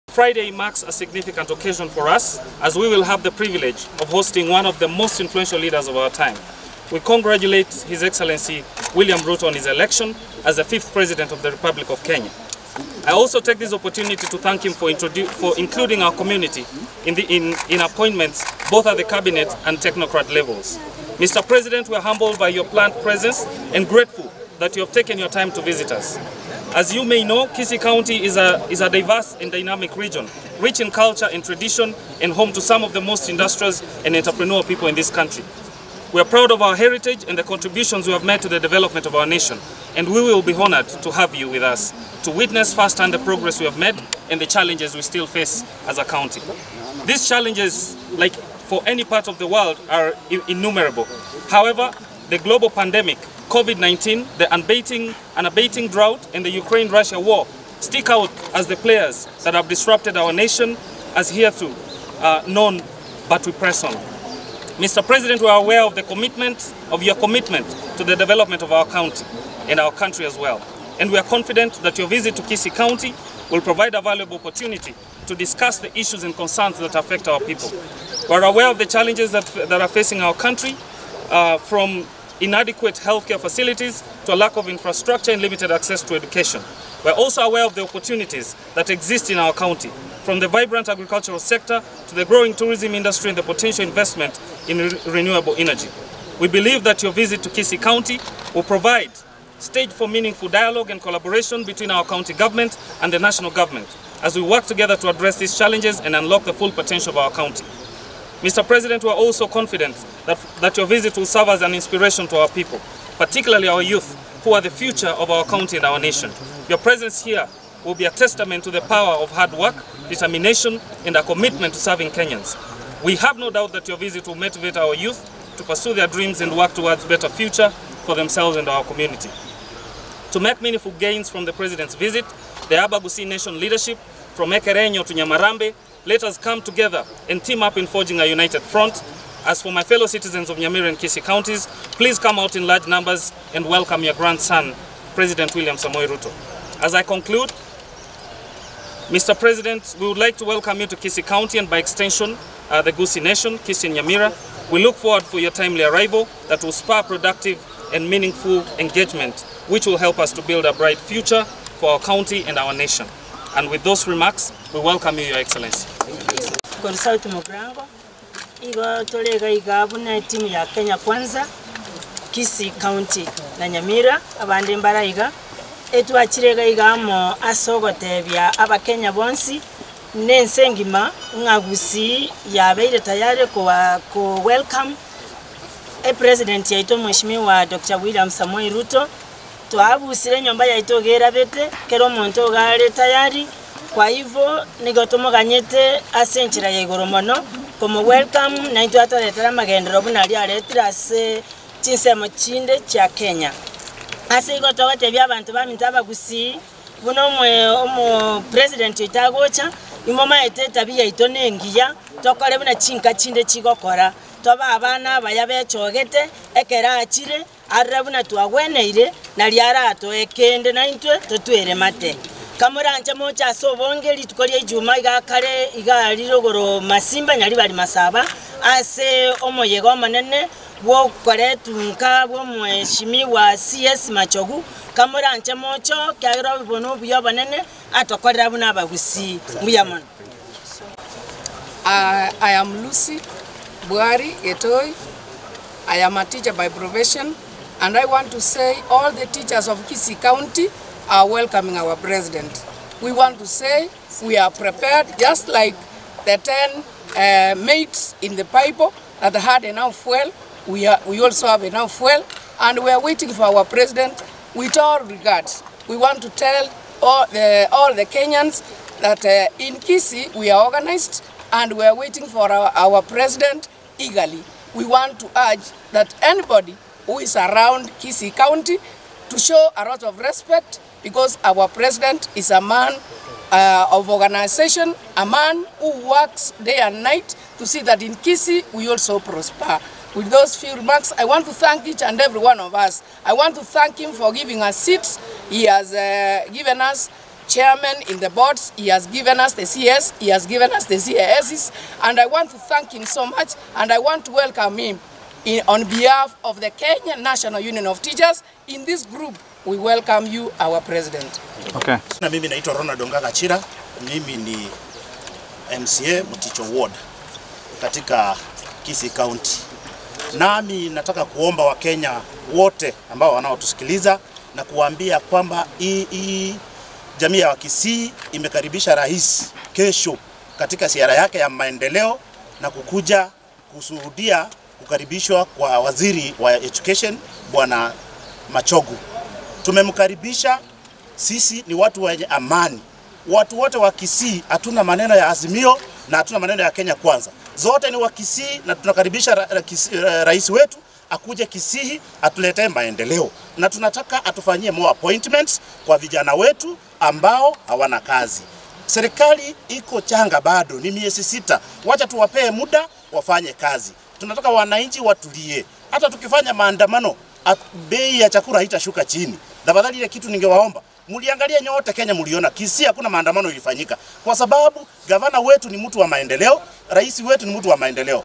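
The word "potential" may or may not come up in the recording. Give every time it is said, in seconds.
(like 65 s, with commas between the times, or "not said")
93 s, 106 s.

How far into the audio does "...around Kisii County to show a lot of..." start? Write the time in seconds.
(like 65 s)
277 s.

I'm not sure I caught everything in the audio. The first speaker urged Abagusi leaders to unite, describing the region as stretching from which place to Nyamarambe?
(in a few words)
Ekerenyo.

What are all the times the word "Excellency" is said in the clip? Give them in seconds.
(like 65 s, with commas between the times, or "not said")
8 s, 165 s.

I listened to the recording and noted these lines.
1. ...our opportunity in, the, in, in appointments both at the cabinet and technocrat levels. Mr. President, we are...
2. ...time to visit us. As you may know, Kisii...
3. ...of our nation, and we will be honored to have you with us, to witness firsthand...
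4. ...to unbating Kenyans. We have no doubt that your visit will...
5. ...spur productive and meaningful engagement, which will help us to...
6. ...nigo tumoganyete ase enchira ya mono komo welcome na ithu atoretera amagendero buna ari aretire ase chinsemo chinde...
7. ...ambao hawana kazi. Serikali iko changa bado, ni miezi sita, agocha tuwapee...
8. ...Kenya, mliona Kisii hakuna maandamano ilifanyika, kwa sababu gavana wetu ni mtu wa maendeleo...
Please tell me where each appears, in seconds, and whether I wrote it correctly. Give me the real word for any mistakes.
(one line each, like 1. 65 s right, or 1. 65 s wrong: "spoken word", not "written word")
1. 16 s wrong: "community", not "opportunity"
2. 25 s right
3. 39 s right
4. 121 s wrong: "serving", not "unbating"
5. 156 s right
6. 194 s right
7. 356 s wrong: "wacha", not "agocha"
8. 371 s right.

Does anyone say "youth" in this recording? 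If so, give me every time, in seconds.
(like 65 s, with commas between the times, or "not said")
113 s, 124 s.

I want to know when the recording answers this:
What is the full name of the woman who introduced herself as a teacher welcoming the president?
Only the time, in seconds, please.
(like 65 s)
242 s.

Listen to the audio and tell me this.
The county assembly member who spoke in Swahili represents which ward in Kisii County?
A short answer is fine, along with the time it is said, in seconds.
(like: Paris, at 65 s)
Muticho Ward, at 316 s.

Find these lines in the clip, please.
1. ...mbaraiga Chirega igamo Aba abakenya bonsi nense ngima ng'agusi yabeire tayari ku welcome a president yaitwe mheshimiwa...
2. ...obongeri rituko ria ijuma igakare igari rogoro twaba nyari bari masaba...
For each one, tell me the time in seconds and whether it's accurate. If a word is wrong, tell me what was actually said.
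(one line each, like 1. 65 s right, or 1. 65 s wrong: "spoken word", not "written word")
1. 174 s right
2. 223 s wrong: "masimba", not "twaba".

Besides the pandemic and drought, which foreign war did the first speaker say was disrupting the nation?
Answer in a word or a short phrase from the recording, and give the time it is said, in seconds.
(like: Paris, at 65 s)
Ukraine-Russia war, at 56 s.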